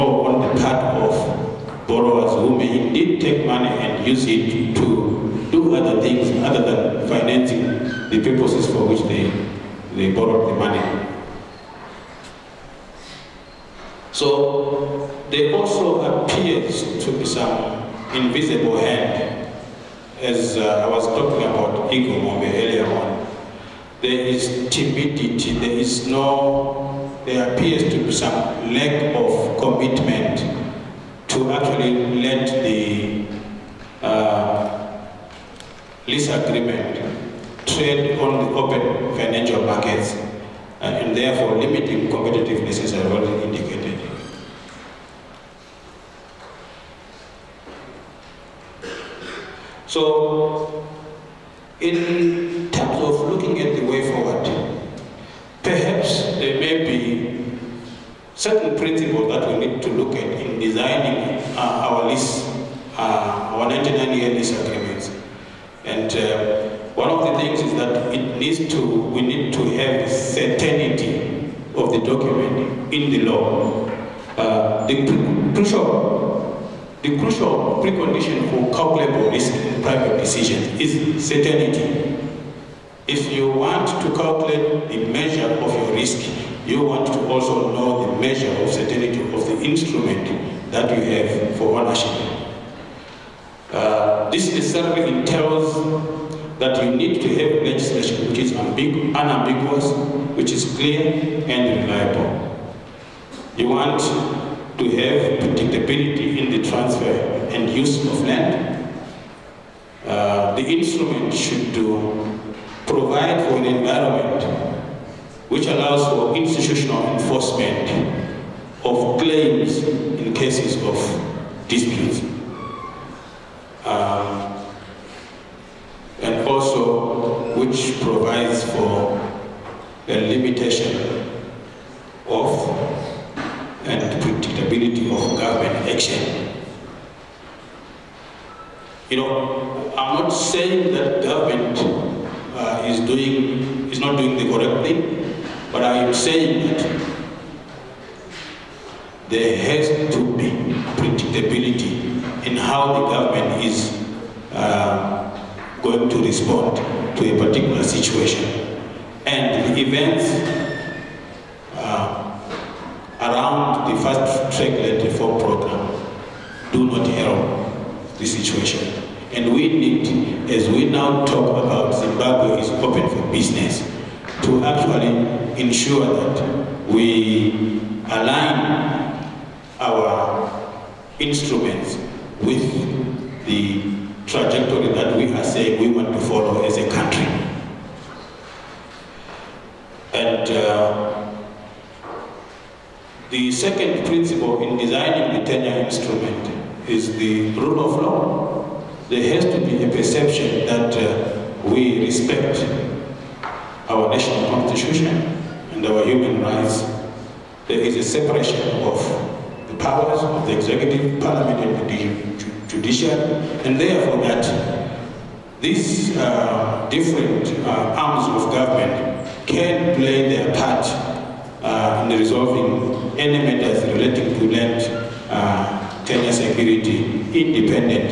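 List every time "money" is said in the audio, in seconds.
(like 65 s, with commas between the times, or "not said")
3 s, 10 s.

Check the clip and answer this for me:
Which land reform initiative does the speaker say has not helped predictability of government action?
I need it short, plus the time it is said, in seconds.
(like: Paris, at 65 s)
Fast track land reform program, at 164 s.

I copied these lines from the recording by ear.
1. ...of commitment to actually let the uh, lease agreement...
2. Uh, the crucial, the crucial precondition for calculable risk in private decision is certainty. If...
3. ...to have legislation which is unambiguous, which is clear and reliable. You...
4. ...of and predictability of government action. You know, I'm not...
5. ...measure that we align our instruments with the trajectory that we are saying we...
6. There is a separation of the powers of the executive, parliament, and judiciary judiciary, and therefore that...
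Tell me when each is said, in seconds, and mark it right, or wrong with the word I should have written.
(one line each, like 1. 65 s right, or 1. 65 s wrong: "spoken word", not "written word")
1. 29 s right
2. 74 s right
3. 97 s right
4. 132 s right
5. 175 s wrong: "ensure", not "measure"
6. 207 s right.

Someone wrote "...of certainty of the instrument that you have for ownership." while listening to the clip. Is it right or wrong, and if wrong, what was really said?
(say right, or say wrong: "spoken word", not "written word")
right.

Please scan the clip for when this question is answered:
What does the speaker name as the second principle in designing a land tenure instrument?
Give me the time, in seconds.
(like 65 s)
197 s.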